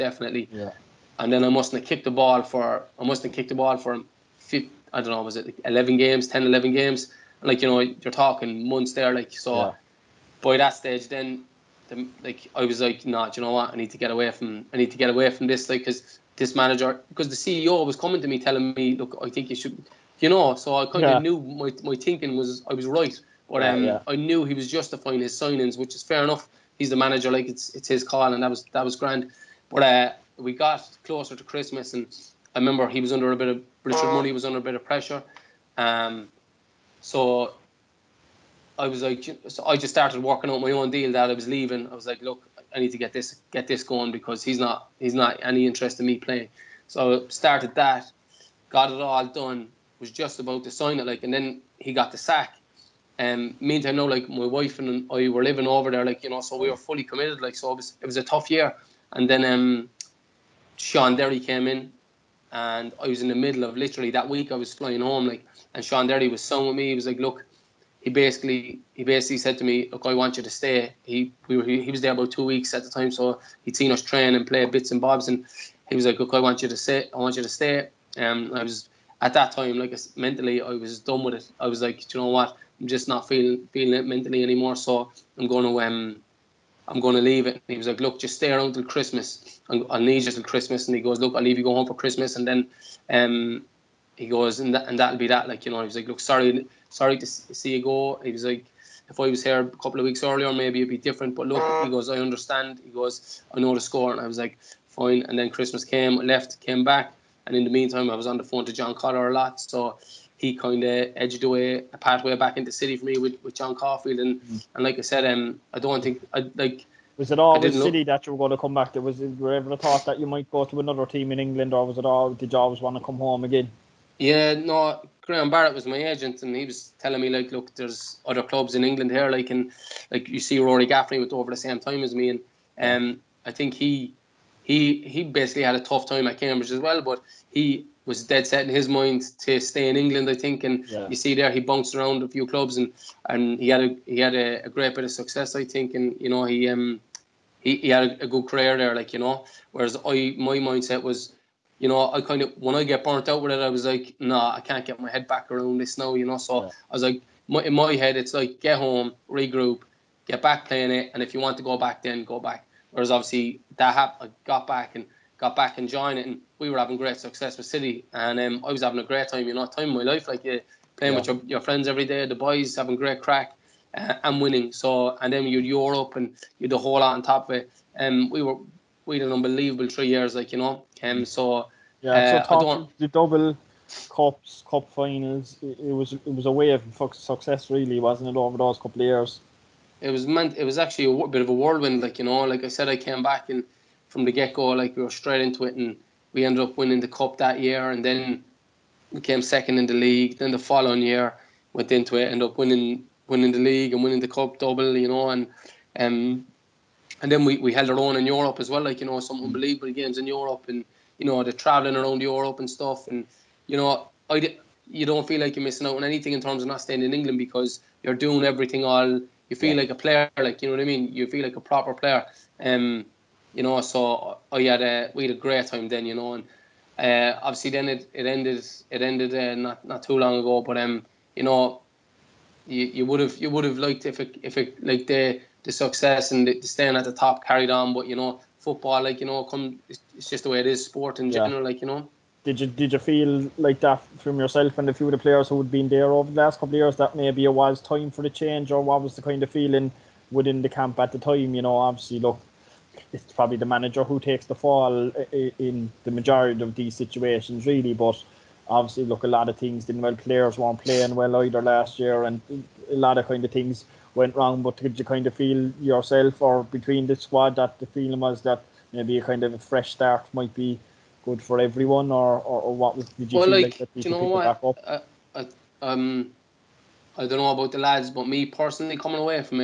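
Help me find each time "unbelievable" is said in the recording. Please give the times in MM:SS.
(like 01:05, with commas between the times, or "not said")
02:59, 03:29.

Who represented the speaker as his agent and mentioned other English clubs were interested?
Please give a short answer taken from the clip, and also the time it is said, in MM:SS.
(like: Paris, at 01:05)
Graham Barrett, at 02:05.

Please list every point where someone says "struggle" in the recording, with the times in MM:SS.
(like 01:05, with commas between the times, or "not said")
not said.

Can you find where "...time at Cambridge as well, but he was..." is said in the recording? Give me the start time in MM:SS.
02:16.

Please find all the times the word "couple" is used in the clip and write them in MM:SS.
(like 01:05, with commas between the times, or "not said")
01:39, 03:08, 04:06.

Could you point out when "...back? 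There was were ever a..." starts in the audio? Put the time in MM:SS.
01:58.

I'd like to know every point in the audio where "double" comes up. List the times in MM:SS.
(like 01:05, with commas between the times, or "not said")
03:03, 03:24.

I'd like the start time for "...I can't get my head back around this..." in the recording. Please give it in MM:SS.
02:34.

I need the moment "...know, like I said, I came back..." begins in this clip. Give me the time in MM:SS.
03:12.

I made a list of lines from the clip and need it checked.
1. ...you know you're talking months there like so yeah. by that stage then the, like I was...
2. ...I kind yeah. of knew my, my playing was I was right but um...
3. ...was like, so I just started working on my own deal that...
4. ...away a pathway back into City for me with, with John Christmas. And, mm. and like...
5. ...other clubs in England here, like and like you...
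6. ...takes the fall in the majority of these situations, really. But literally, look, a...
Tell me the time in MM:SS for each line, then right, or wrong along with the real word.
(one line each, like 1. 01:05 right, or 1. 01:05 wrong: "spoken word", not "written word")
1. 00:07 right
2. 00:20 wrong: "thinking", not "playing"
3. 00:38 right
4. 01:51 wrong: "Caulfield", not "Christmas"
5. 02:08 right
6. 04:14 wrong: "obviously", not "literally".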